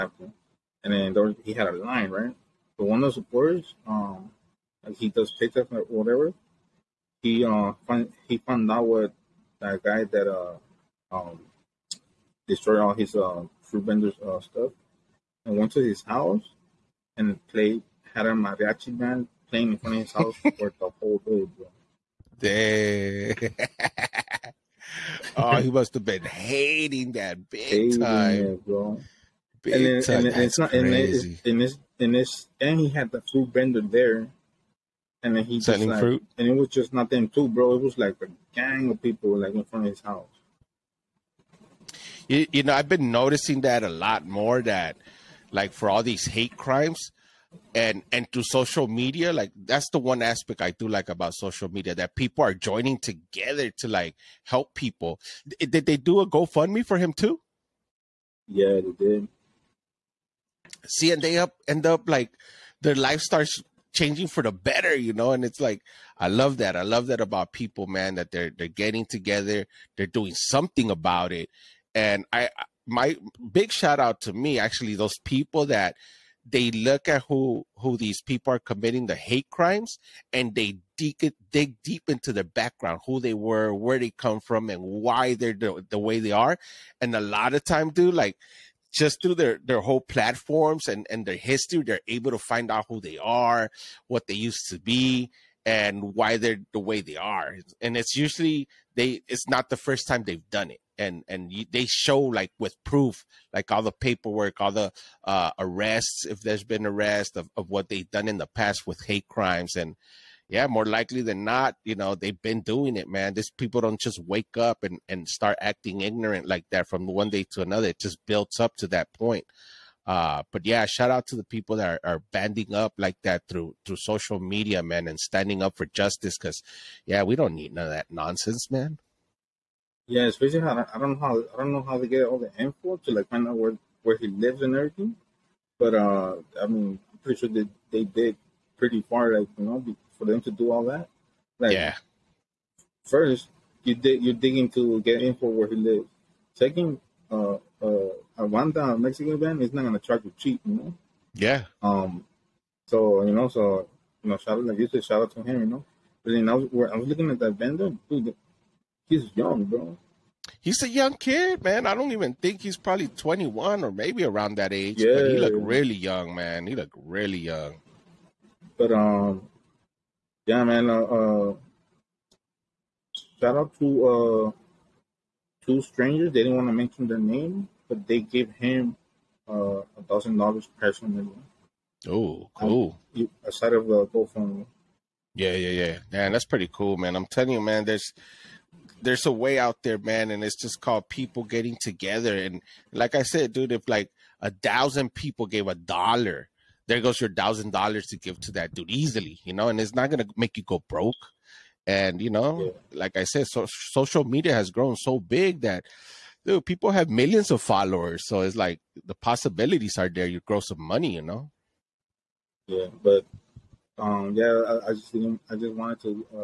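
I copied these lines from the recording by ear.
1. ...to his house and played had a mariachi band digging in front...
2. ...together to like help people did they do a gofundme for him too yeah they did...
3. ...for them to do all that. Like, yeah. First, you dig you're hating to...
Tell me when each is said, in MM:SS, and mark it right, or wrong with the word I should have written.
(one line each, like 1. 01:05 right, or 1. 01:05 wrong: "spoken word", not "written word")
1. 00:15 wrong: "playing", not "digging"
2. 00:52 right
3. 02:20 wrong: "digging", not "hating".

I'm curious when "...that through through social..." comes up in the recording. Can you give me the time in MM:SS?
02:03.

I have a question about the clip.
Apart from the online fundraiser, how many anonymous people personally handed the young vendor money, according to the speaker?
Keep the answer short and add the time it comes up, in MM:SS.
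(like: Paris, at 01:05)
2, at 02:55.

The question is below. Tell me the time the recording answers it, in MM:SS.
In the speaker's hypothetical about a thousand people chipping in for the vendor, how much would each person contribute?
03:15.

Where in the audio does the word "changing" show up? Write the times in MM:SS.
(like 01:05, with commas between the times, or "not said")
01:03.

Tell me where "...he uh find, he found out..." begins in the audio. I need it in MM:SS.
00:07.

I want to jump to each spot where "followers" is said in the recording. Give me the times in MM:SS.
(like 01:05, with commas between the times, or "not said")
03:27.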